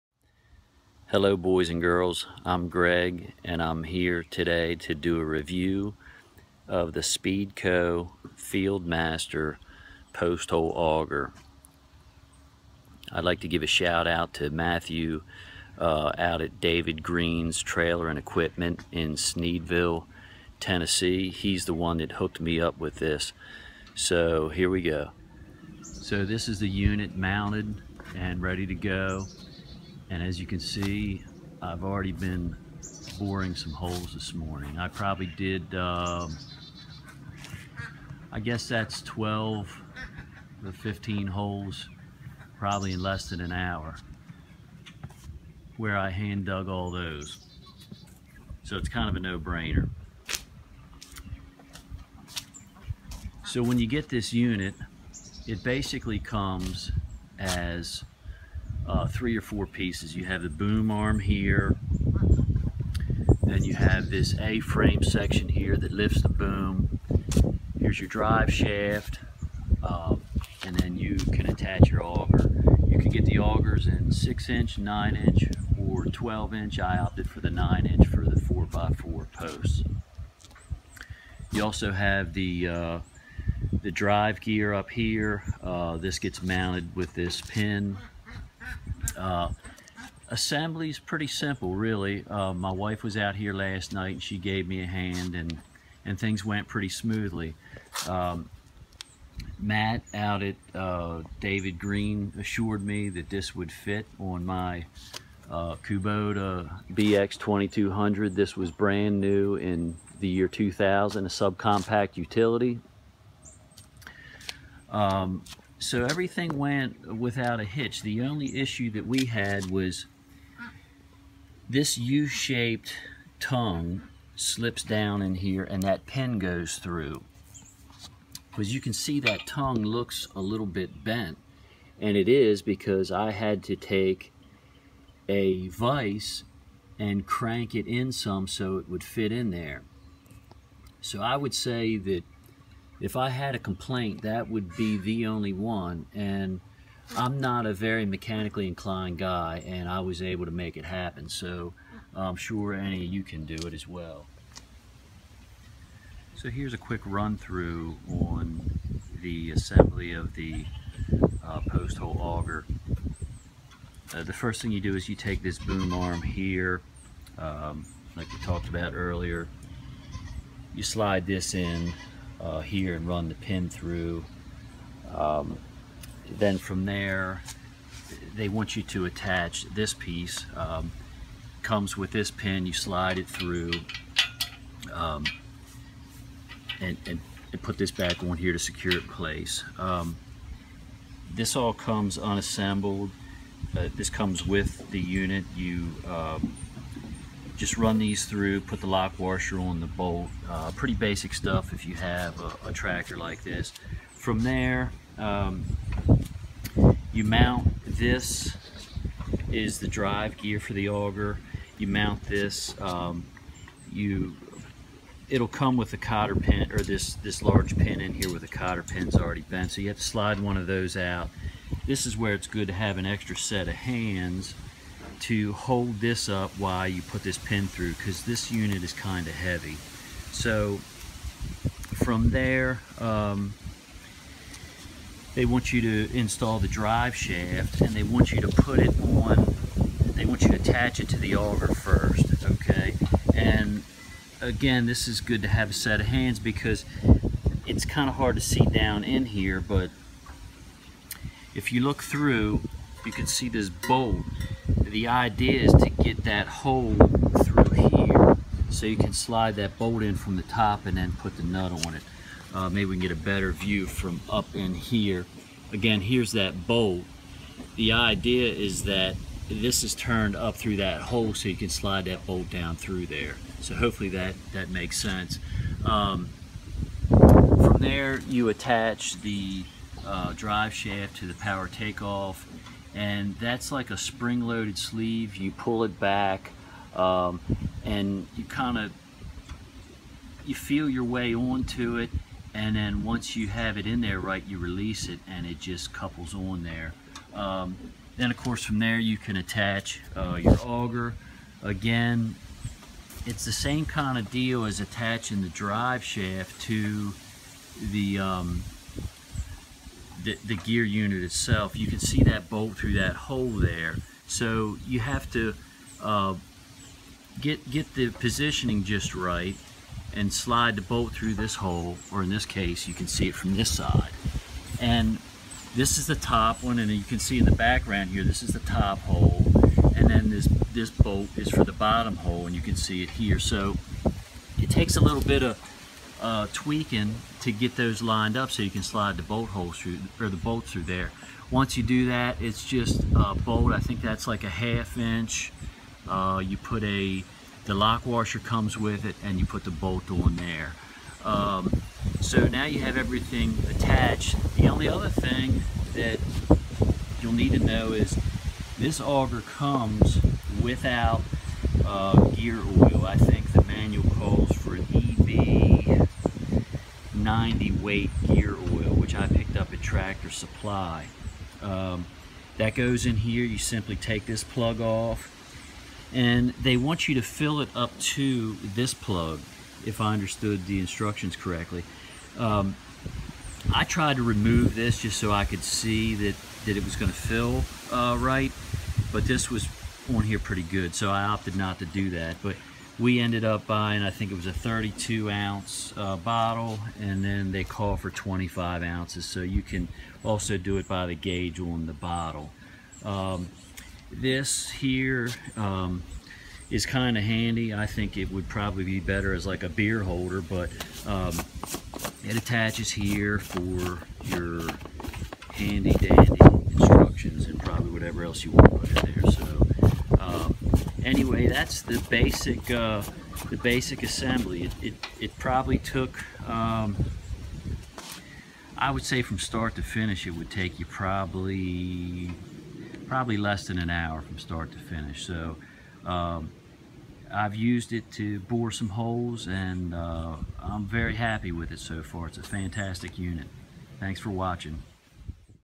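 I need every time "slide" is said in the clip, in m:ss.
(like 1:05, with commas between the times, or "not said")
2:50, 3:02, 3:40, 4:19, 4:31, 5:20, 5:38.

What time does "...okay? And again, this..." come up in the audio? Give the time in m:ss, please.
4:02.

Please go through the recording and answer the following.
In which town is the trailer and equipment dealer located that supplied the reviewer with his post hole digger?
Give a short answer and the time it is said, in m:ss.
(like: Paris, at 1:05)
Sneedville, Tennessee, at 0:19.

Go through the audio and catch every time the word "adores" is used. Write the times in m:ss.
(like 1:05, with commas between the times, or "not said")
not said.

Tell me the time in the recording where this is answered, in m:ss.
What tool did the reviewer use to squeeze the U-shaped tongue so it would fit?
2:15.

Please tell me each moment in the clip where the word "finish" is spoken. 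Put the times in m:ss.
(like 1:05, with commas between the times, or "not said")
7:09, 7:14.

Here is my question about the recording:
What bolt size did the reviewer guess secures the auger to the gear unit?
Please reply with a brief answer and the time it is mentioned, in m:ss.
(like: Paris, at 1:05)
Half inch, at 5:44.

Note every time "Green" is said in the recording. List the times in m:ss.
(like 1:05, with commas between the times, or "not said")
0:17, 1:41.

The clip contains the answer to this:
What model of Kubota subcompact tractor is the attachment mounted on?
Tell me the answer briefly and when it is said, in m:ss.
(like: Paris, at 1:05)
BX2200, at 1:46.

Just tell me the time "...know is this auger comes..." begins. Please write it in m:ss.
5:57.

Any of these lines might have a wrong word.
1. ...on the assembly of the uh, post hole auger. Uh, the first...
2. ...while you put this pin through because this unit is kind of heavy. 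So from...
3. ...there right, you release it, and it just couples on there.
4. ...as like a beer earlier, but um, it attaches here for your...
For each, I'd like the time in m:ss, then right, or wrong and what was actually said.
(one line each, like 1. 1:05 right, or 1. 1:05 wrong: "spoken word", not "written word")
1. 2:38 right
2. 3:46 right
3. 4:54 right
4. 6:49 wrong: "holder", not "earlier".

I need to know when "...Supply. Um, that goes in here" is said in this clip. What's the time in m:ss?
6:10.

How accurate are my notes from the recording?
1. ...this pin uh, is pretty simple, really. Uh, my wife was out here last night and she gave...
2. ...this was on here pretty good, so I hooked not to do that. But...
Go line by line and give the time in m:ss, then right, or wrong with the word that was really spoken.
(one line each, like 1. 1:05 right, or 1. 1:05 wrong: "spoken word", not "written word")
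1. 1:27 right
2. 6:29 wrong: "opted", not "hooked".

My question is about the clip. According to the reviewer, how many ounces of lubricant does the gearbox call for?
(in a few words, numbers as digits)
25 ounces.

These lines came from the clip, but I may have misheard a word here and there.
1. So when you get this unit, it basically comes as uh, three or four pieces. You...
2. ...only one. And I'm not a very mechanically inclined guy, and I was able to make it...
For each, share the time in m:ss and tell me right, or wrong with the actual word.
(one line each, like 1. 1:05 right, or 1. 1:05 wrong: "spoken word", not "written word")
1. 0:53 right
2. 2:25 right.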